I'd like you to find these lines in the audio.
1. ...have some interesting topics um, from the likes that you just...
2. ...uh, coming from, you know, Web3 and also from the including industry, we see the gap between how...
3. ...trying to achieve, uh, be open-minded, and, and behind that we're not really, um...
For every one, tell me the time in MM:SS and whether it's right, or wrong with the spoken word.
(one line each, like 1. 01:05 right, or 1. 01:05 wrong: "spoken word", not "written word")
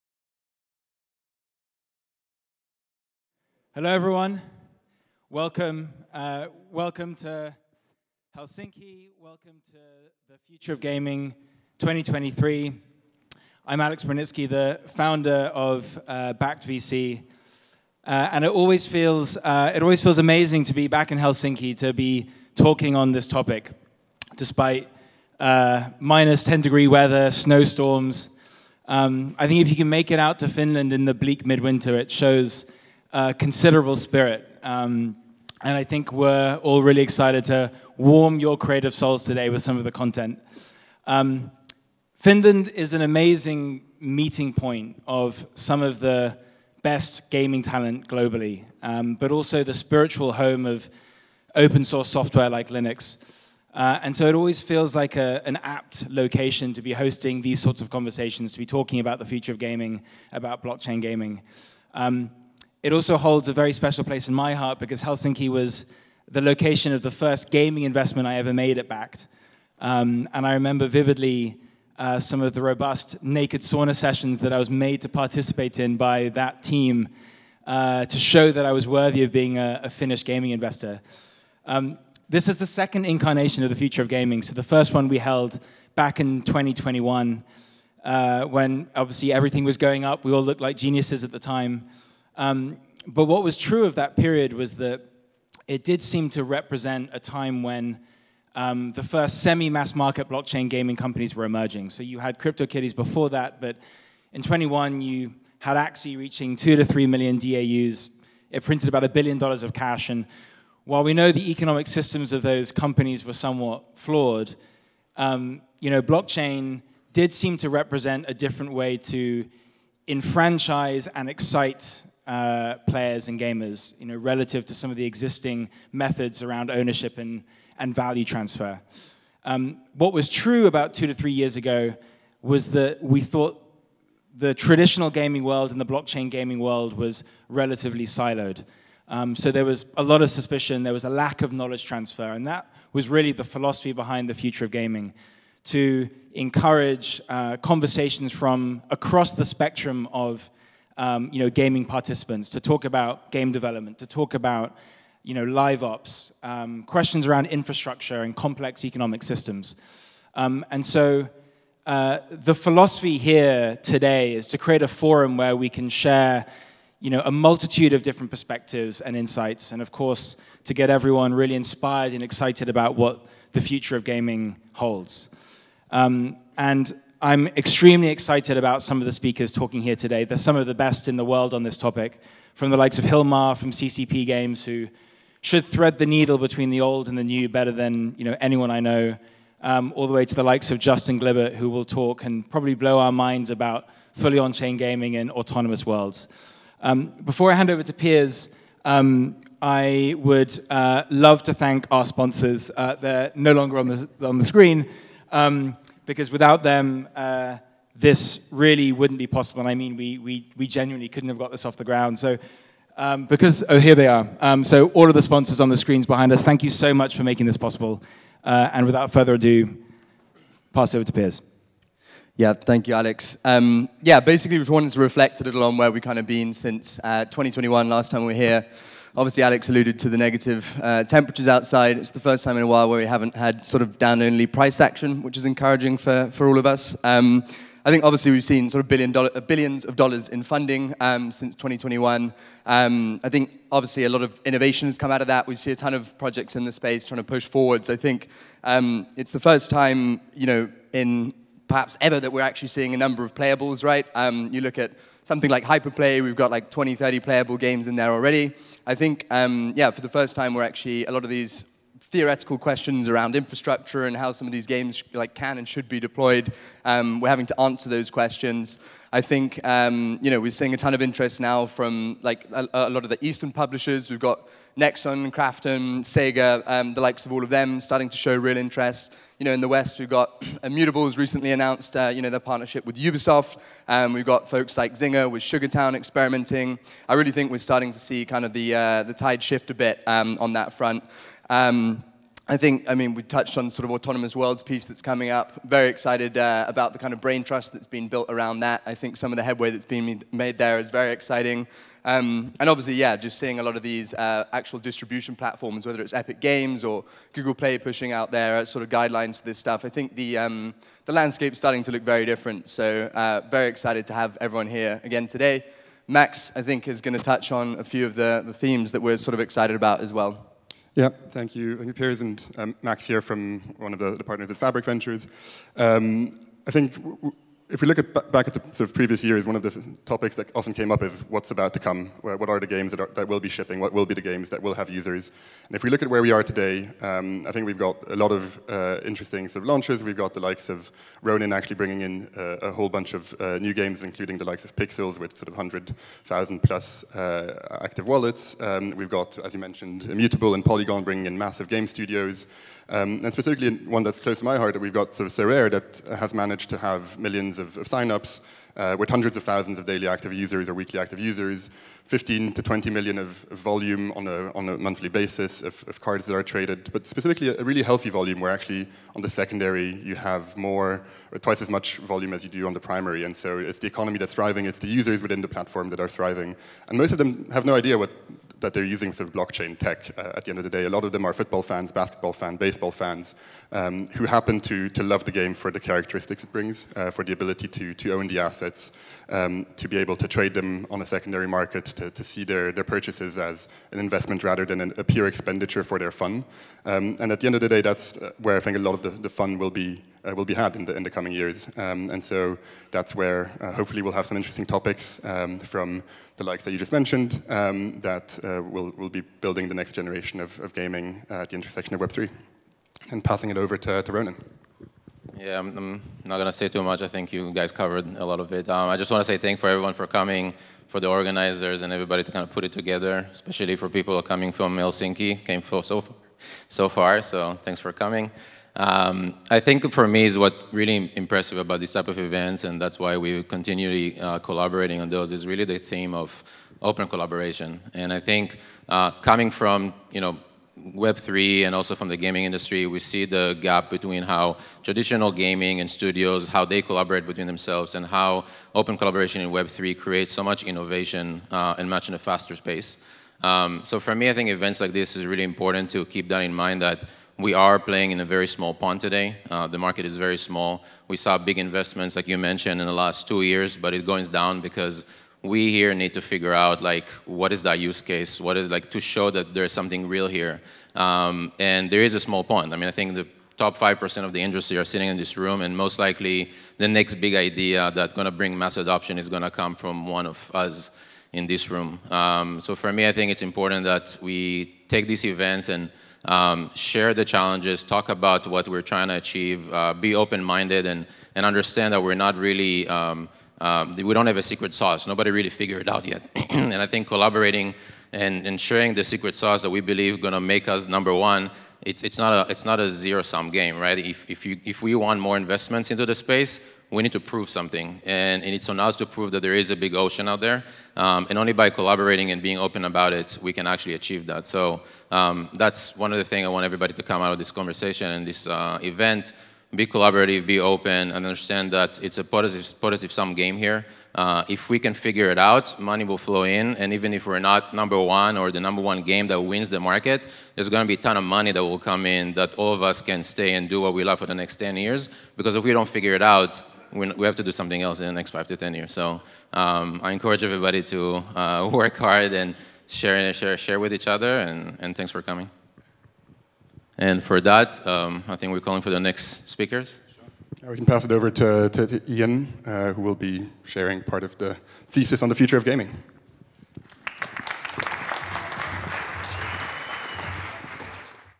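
1. 06:44 right
2. 07:18 wrong: "gaming", not "including"
3. 08:08 wrong: "understand", not "behind".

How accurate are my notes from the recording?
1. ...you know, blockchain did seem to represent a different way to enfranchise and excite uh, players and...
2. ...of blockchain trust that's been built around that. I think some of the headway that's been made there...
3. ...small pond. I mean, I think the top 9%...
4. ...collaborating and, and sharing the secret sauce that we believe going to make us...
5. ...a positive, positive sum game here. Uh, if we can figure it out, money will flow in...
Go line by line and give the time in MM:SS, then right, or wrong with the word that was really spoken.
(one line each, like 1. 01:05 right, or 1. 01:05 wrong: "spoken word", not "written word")
1. 01:55 right
2. 04:57 wrong: "brain", not "blockchain"
3. 07:52 wrong: "5", not "9"
4. 08:17 right
5. 08:42 right.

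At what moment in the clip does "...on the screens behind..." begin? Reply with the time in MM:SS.
03:35.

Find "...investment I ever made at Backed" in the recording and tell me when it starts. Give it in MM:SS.
01:07.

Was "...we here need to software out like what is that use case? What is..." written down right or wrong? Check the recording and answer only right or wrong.
wrong.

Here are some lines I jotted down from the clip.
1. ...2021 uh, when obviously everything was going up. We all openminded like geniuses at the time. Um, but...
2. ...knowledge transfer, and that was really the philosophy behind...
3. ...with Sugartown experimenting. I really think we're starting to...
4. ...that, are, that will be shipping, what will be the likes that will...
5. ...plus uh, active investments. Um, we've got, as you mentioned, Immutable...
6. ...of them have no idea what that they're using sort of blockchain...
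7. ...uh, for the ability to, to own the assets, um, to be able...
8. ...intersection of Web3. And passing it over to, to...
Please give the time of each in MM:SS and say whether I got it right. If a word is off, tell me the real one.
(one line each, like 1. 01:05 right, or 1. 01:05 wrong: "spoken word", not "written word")
1. 01:26 wrong: "looked", not "openminded"
2. 02:21 right
3. 04:45 right
4. 05:32 wrong: "games", not "likes"
5. 05:46 wrong: "wallets", not "investments"
6. 06:17 right
7. 06:26 right
8. 06:51 right.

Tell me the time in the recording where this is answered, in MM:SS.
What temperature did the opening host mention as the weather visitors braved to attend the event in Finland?
00:26.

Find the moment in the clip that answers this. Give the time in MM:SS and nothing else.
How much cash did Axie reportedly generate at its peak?
01:48.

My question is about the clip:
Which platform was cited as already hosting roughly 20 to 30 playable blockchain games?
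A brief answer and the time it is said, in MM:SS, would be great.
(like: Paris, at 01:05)
Hyperplay, at 04:15.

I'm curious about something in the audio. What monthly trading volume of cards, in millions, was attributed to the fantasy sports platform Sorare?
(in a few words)
15 to 20 million.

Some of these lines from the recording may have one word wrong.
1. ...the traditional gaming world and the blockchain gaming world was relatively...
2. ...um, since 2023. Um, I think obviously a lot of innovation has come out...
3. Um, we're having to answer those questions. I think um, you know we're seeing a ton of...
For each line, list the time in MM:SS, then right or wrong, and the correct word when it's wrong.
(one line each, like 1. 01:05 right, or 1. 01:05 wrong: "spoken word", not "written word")
1. 02:14 right
2. 04:00 wrong: "2021", not "2023"
3. 04:26 right.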